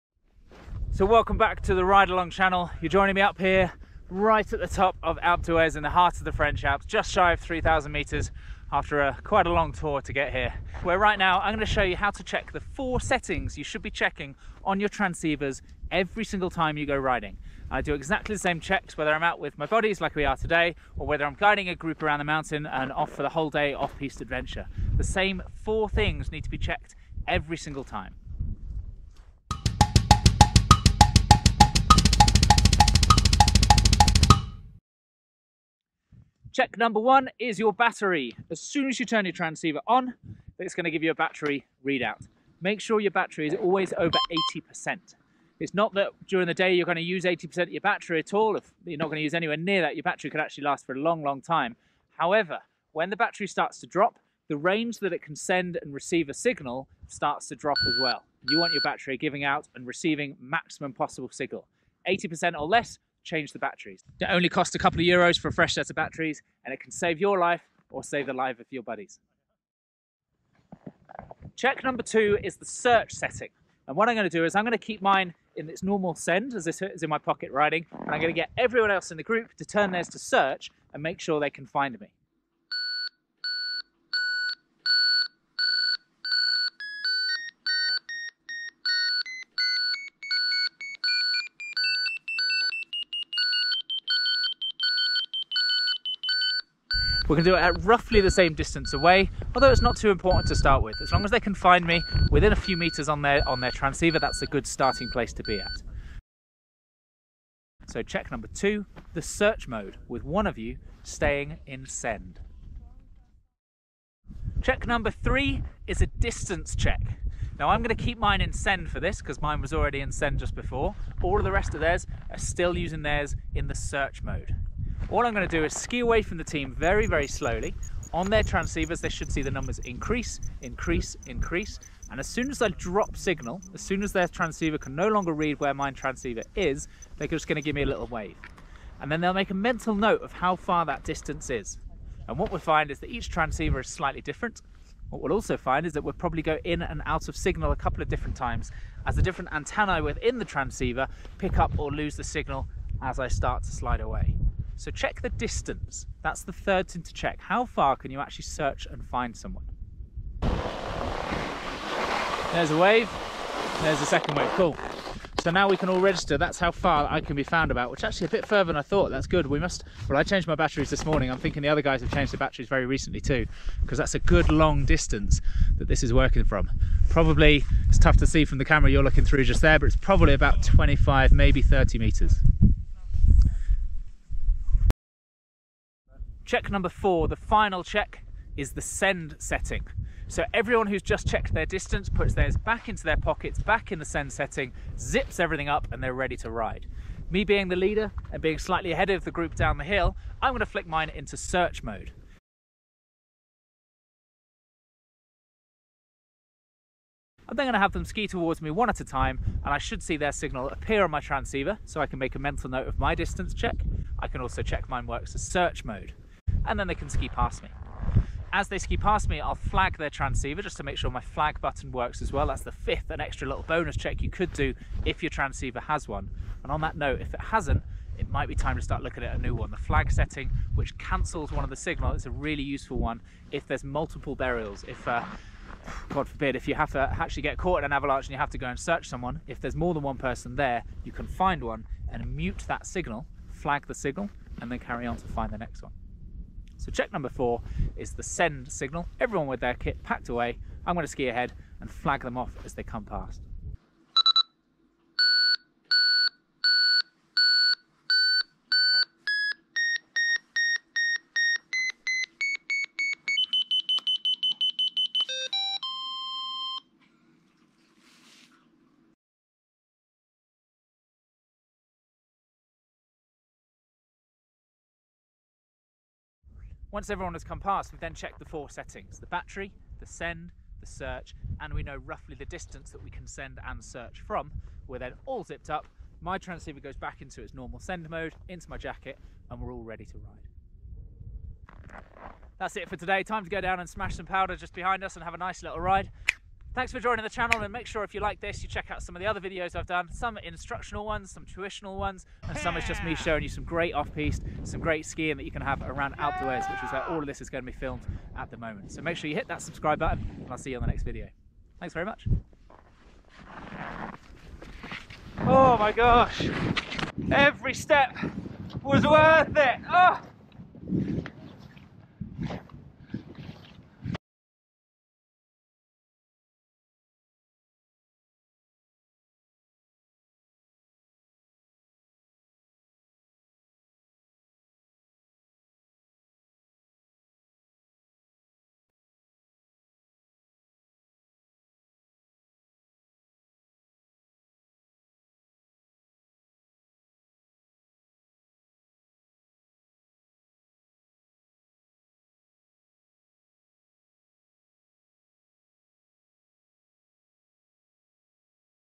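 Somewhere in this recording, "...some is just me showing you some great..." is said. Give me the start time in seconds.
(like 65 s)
302 s.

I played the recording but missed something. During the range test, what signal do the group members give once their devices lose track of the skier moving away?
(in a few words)
A little wave.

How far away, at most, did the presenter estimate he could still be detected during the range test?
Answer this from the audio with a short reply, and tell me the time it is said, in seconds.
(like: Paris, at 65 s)
30 meters, at 181 s.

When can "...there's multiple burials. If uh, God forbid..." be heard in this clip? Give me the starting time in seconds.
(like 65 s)
233 s.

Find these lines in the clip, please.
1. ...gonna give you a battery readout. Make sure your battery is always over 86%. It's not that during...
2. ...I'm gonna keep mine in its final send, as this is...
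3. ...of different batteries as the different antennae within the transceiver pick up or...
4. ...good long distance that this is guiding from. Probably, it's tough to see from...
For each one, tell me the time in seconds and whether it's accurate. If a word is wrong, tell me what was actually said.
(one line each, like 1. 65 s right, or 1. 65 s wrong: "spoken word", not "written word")
1. 40 s wrong: "80", not "86"
2. 74 s wrong: "normal", not "final"
3. 148 s wrong: "times", not "batteries"
4. 174 s wrong: "working", not "guiding".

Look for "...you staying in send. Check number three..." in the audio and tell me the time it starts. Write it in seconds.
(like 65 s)
110 s.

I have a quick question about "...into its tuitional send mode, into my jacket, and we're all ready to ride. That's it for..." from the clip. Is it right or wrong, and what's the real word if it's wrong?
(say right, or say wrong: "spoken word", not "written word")
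wrong: "normal", not "tuitional".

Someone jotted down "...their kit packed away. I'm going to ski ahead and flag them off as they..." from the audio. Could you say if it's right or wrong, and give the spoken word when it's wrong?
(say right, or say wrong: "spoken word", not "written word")
right.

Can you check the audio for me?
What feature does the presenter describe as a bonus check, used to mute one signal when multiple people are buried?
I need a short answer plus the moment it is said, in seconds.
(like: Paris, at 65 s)
Flag button, at 221 s.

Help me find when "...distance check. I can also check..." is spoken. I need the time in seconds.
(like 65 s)
213 s.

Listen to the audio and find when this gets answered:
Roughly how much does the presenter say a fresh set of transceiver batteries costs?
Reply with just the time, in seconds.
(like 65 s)
64 s.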